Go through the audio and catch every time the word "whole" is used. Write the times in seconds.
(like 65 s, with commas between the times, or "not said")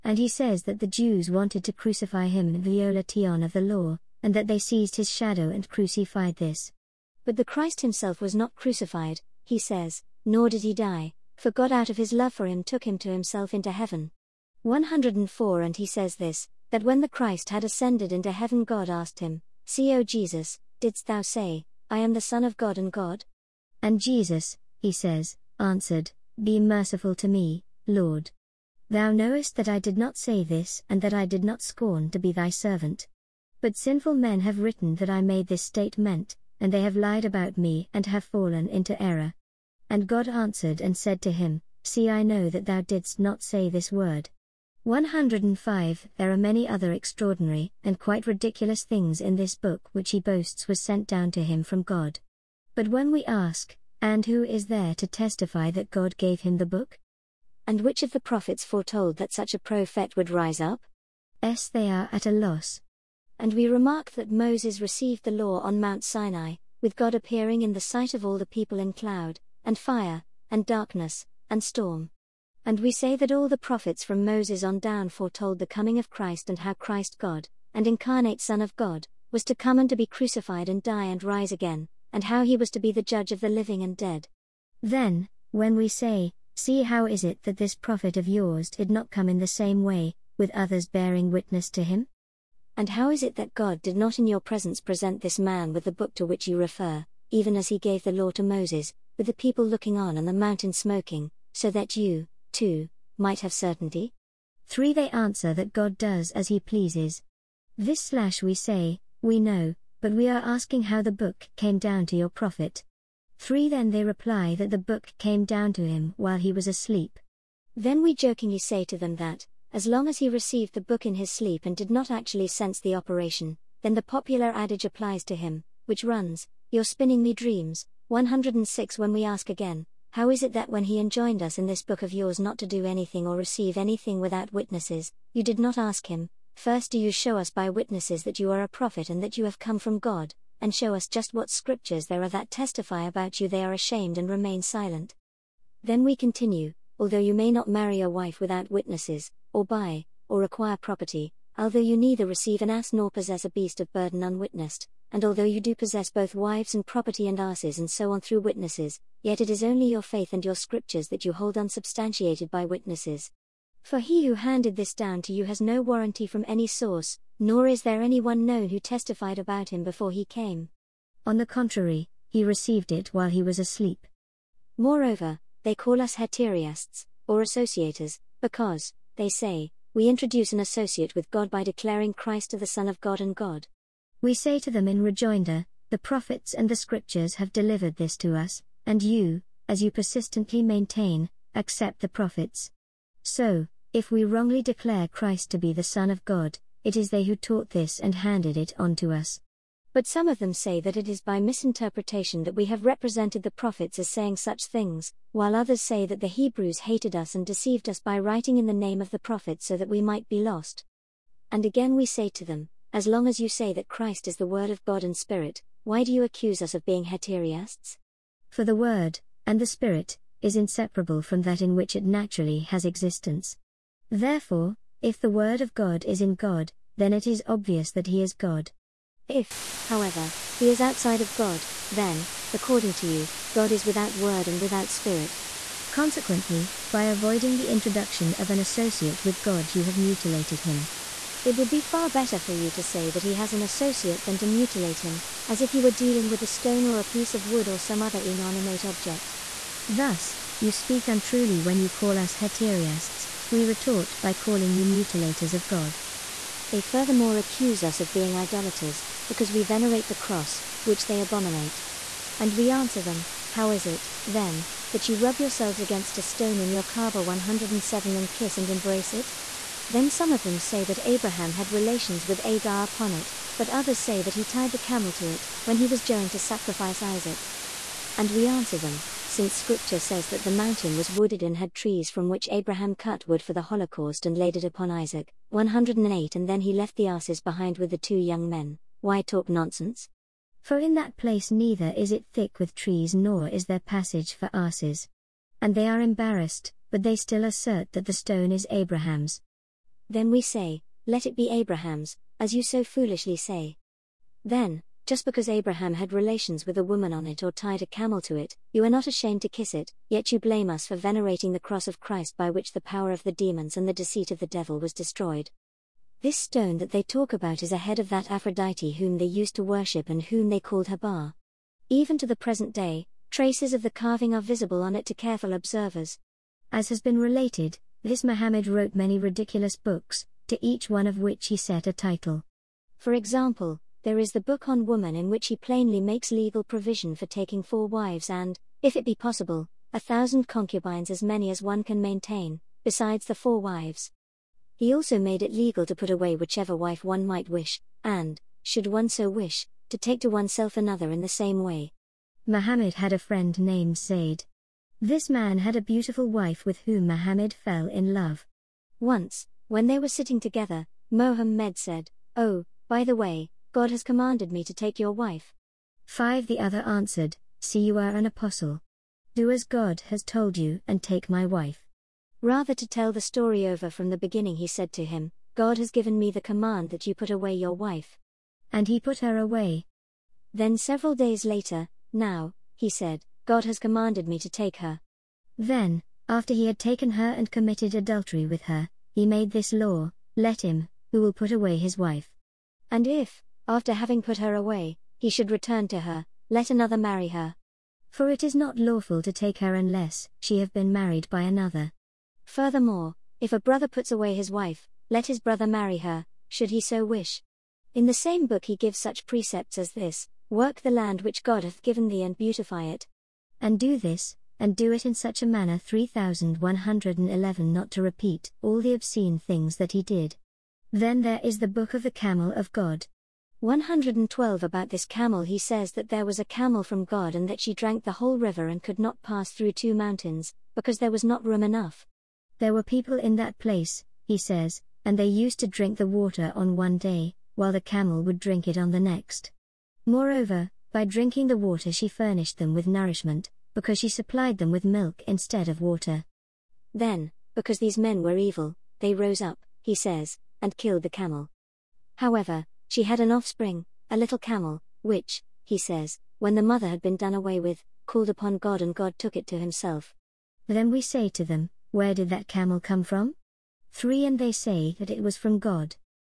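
428 s.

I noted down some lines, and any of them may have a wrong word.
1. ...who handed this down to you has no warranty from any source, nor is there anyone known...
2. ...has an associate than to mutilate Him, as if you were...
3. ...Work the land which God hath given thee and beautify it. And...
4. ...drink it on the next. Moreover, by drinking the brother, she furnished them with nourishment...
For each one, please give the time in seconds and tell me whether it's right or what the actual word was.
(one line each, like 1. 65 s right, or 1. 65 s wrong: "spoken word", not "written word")
1. 164 s right
2. 243 s right
3. 410 s right
4. 438 s wrong: "water", not "brother".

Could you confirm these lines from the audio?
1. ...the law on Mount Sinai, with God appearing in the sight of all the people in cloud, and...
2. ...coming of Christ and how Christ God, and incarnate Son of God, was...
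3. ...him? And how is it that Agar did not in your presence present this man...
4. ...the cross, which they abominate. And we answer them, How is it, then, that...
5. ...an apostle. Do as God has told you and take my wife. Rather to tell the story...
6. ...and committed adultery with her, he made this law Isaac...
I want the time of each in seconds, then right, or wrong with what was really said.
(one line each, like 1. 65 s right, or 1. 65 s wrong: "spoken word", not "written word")
1. 65 s right
2. 75 s right
3. 91 s wrong: "God", not "Agar"
4. 260 s right
5. 368 s right
6. 387 s wrong: "Let", not "Isaac".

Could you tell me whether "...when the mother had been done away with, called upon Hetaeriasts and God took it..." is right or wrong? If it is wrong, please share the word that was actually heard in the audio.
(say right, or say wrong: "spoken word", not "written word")
wrong: "God", not "Hetaeriasts".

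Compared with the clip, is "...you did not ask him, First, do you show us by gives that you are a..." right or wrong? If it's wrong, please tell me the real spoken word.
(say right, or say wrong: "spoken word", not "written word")
wrong: "witnesses", not "gives".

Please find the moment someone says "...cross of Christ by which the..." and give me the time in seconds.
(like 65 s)
311 s.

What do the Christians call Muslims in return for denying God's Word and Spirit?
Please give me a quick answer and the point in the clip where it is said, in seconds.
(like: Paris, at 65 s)
mutilators of God, at 254 s.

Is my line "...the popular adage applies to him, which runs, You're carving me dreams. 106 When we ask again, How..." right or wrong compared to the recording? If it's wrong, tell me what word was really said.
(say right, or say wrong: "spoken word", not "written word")
wrong: "spinning", not "carving".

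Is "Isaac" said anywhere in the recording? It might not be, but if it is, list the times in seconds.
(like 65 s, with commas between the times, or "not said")
276 s, 284 s.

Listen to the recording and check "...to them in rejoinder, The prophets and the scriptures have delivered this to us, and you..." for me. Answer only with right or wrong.
right.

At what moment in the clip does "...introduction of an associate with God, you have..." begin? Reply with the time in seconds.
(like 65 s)
237 s.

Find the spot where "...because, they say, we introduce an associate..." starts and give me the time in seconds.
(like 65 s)
178 s.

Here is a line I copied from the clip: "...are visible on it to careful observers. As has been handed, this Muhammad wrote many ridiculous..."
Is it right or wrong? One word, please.
wrong.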